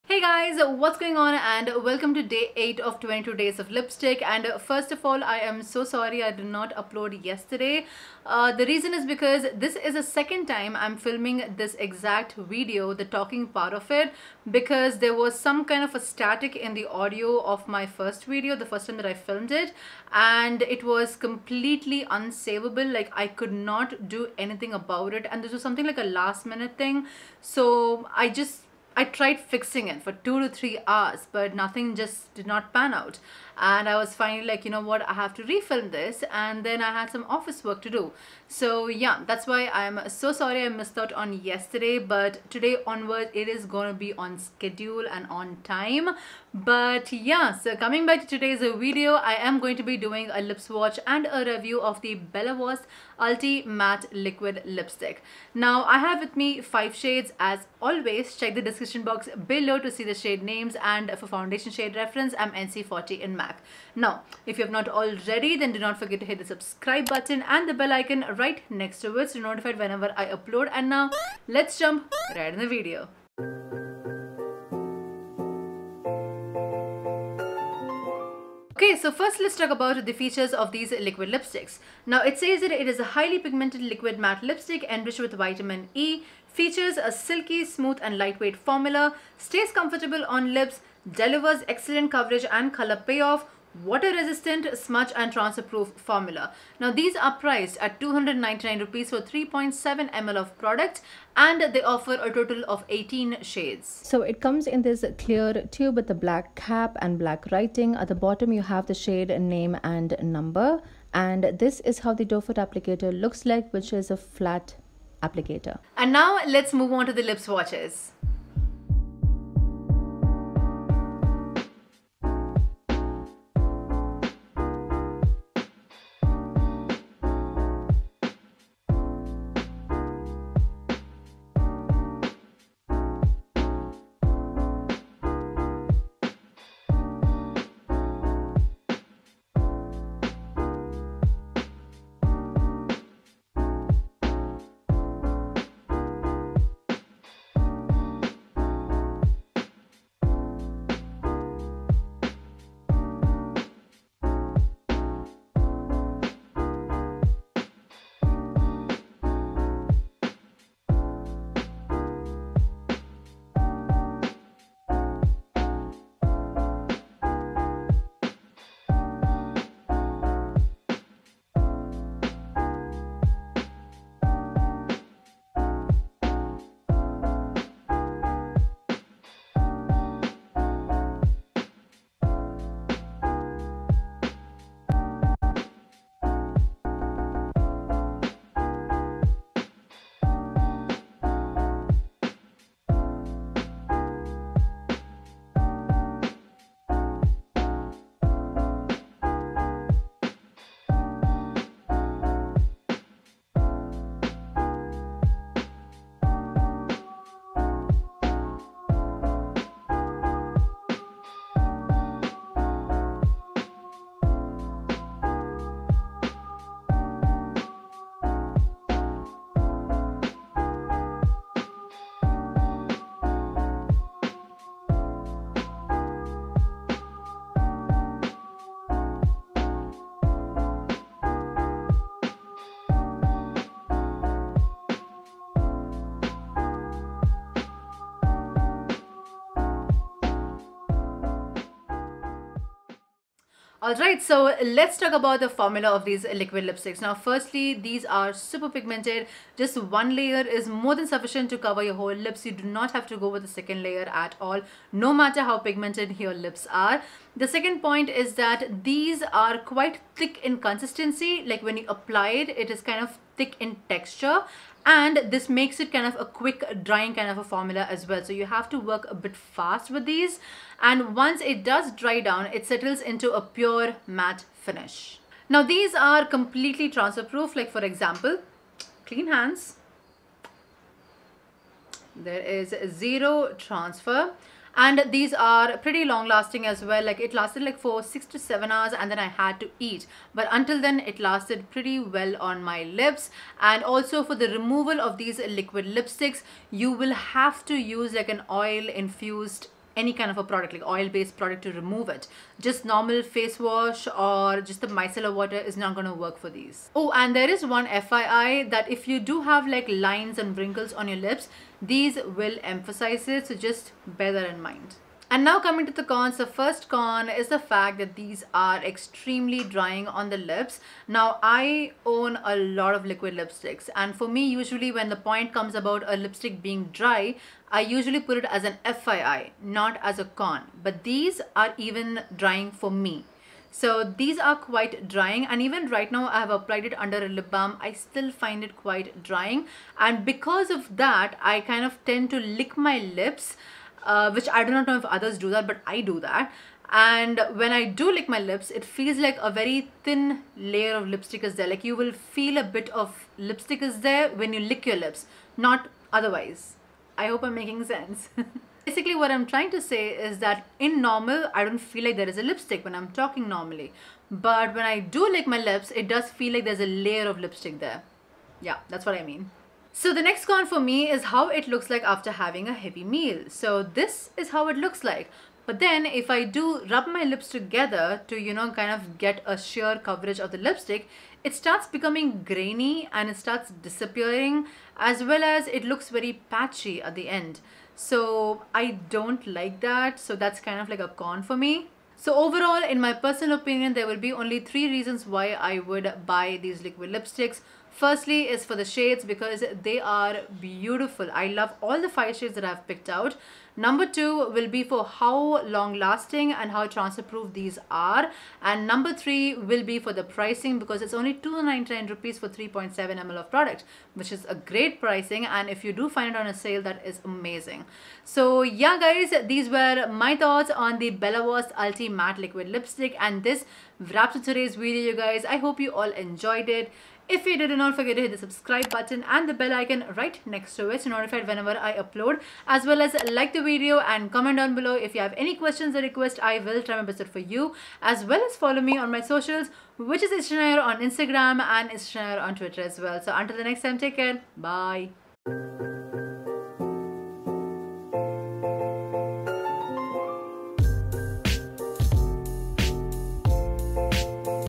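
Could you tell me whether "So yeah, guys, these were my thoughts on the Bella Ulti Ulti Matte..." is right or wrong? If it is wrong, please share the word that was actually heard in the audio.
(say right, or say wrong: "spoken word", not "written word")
wrong: "Voste", not "Ulti".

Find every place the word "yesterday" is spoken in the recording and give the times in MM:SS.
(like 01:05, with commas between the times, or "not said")
00:07, 00:41.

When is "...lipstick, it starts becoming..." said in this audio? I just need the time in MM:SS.
06:20.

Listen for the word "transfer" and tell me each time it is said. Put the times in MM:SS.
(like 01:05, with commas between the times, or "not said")
01:35, 04:36, 04:43, 06:46.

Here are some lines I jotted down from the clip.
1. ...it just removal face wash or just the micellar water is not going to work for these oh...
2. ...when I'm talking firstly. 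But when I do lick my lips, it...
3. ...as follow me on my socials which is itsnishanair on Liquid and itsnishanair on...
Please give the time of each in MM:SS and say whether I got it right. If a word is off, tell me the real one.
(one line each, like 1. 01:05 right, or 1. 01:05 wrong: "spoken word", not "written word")
1. 05:02 wrong: "normal", not "removal"
2. 06:02 wrong: "normally", not "firstly"
3. 07:18 wrong: "Instagram", not "Liquid".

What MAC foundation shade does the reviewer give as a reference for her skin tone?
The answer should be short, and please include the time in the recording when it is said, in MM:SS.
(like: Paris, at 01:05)
NC40, at 01:02.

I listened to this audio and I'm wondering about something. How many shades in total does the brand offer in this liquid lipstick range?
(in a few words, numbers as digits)
18.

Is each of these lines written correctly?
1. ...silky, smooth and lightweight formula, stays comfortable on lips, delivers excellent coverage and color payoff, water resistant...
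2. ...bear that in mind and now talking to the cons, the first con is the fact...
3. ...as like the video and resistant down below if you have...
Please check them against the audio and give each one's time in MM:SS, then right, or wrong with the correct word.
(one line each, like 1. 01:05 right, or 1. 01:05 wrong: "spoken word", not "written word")
1. 01:27 right
2. 05:14 wrong: "coming", not "talking"
3. 07:13 wrong: "comment", not "resistant".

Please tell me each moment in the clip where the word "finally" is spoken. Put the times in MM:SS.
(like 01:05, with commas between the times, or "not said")
00:34.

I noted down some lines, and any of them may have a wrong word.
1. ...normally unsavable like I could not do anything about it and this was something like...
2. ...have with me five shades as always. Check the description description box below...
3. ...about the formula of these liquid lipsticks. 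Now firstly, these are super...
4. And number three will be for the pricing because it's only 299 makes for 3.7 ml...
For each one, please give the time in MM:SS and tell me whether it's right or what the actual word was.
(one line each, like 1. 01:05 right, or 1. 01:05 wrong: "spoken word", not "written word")
1. 00:21 wrong: "completely", not "normally"
2. 00:55 right
3. 04:05 right
4. 06:48 wrong: "rupees", not "makes".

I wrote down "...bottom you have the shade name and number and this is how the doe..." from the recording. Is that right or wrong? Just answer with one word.
right.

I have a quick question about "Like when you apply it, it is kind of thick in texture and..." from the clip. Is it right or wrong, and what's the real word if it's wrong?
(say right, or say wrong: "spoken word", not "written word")
right.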